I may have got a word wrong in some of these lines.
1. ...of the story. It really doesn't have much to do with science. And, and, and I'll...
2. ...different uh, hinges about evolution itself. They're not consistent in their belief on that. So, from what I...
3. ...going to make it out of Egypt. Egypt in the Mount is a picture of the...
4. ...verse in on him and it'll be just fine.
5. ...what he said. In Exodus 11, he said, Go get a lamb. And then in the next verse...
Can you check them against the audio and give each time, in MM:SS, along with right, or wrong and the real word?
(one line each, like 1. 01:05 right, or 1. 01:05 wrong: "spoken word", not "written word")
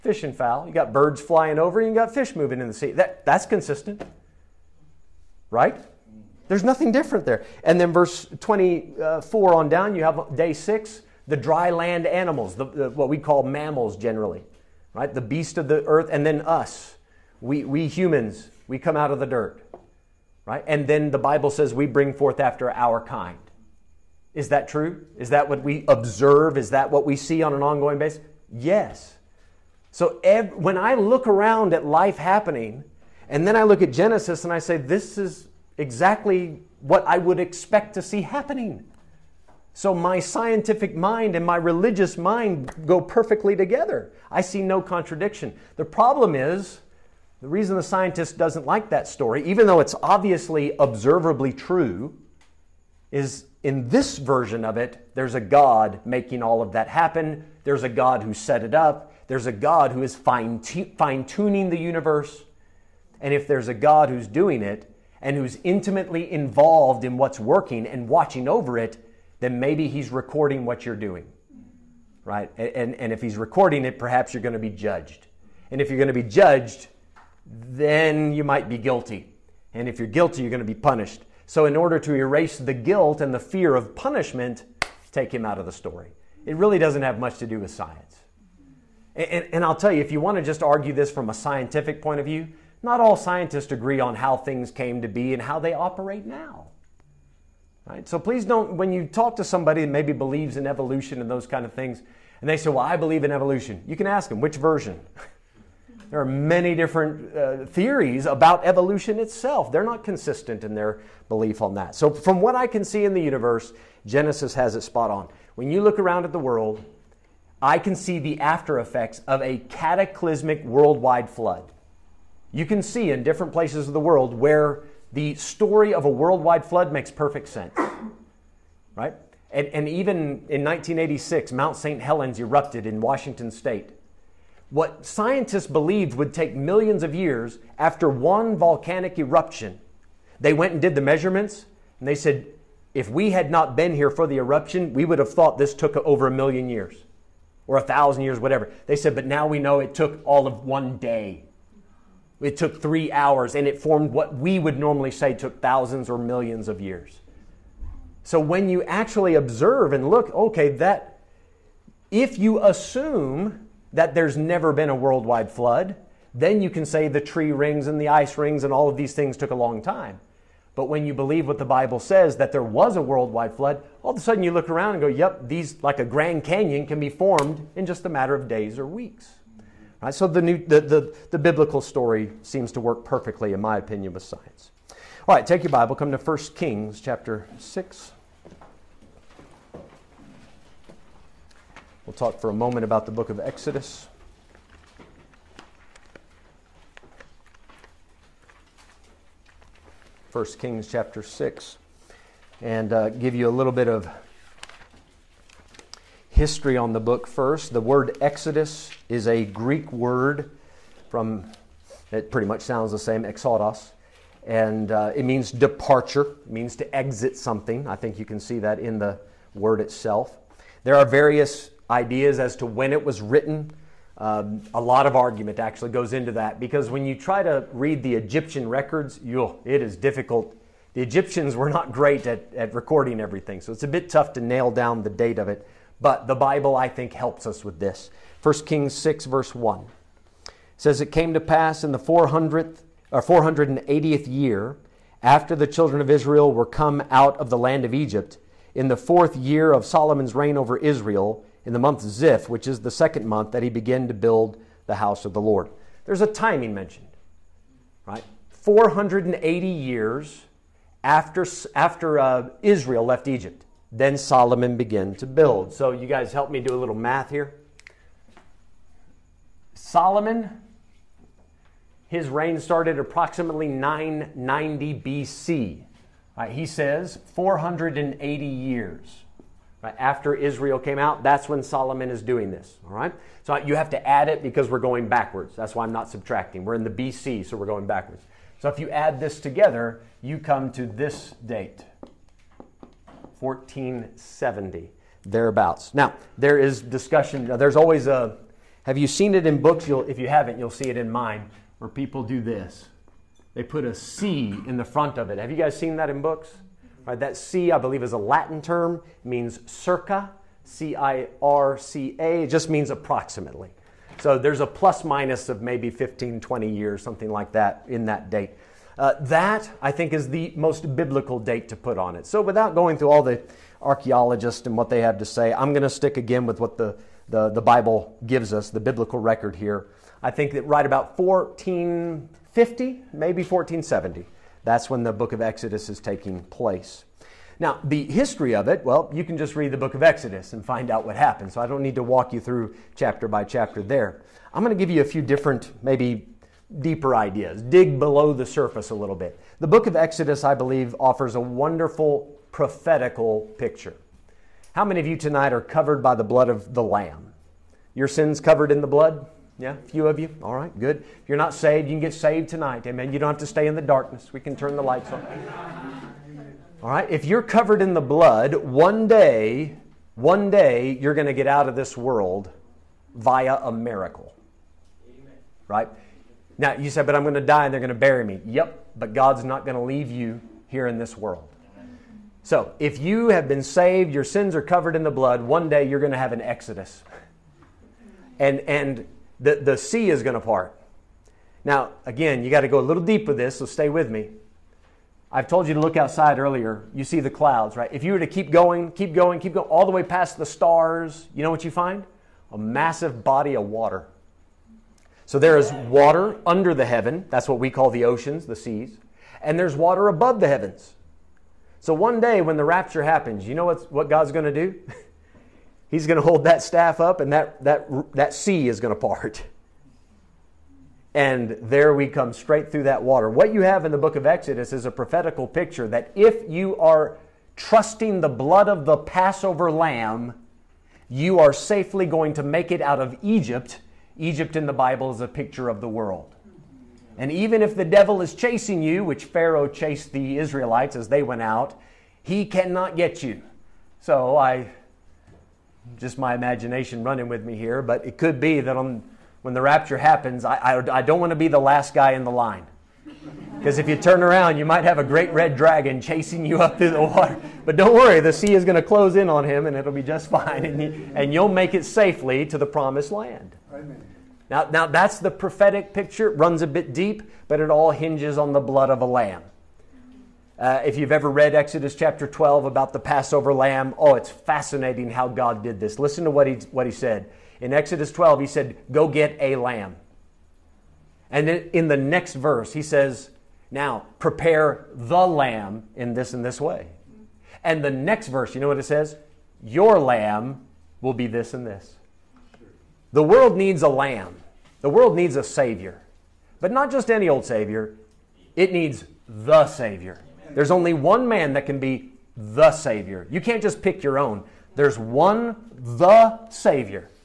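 1. 01:25 right
2. 01:46 wrong: "theories", not "hinges"
3. 07:12 wrong: "Bible", not "Mount"
4. 07:38 wrong: "close", not "verse"
5. 07:56 wrong: "12", not "11".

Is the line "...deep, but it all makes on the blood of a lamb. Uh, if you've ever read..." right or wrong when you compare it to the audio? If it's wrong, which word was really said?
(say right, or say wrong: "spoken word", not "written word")
wrong: "hinges", not "makes".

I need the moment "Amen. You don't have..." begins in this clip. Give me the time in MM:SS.
06:02.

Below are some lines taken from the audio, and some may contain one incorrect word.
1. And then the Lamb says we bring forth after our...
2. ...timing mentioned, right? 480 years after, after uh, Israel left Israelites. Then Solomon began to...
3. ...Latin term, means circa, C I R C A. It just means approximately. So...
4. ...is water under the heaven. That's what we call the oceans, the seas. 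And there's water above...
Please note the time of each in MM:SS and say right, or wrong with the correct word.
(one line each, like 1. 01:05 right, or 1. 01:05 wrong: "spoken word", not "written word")
1. 00:20 wrong: "Bible", not "Lamb"
2. 04:16 wrong: "Egypt", not "Israelites"
3. 05:08 right
4. 06:45 right.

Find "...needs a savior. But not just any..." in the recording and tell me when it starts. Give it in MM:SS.
08:15.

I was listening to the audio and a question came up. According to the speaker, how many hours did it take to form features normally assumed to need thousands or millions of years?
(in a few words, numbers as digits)
3.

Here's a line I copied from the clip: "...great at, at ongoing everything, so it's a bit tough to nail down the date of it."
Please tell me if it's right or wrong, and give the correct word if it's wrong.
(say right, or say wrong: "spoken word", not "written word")
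wrong: "recording", not "ongoing".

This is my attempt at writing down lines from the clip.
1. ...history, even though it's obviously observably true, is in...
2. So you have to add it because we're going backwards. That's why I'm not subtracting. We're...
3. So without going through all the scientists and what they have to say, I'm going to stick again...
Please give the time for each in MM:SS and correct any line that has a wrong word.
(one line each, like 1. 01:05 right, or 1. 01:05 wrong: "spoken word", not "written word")
1. 00:49 wrong: "story", not "history"
2. 04:43 right
3. 05:22 wrong: "archaeologists", not "scientists".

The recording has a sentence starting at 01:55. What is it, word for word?
When you look around at the world, I can see the after effects of a cataclysmic worldwide flood.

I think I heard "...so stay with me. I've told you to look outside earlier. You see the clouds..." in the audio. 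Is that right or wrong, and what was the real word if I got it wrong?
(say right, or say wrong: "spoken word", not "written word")
right.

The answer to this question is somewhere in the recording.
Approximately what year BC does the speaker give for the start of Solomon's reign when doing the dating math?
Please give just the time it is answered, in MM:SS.
04:33.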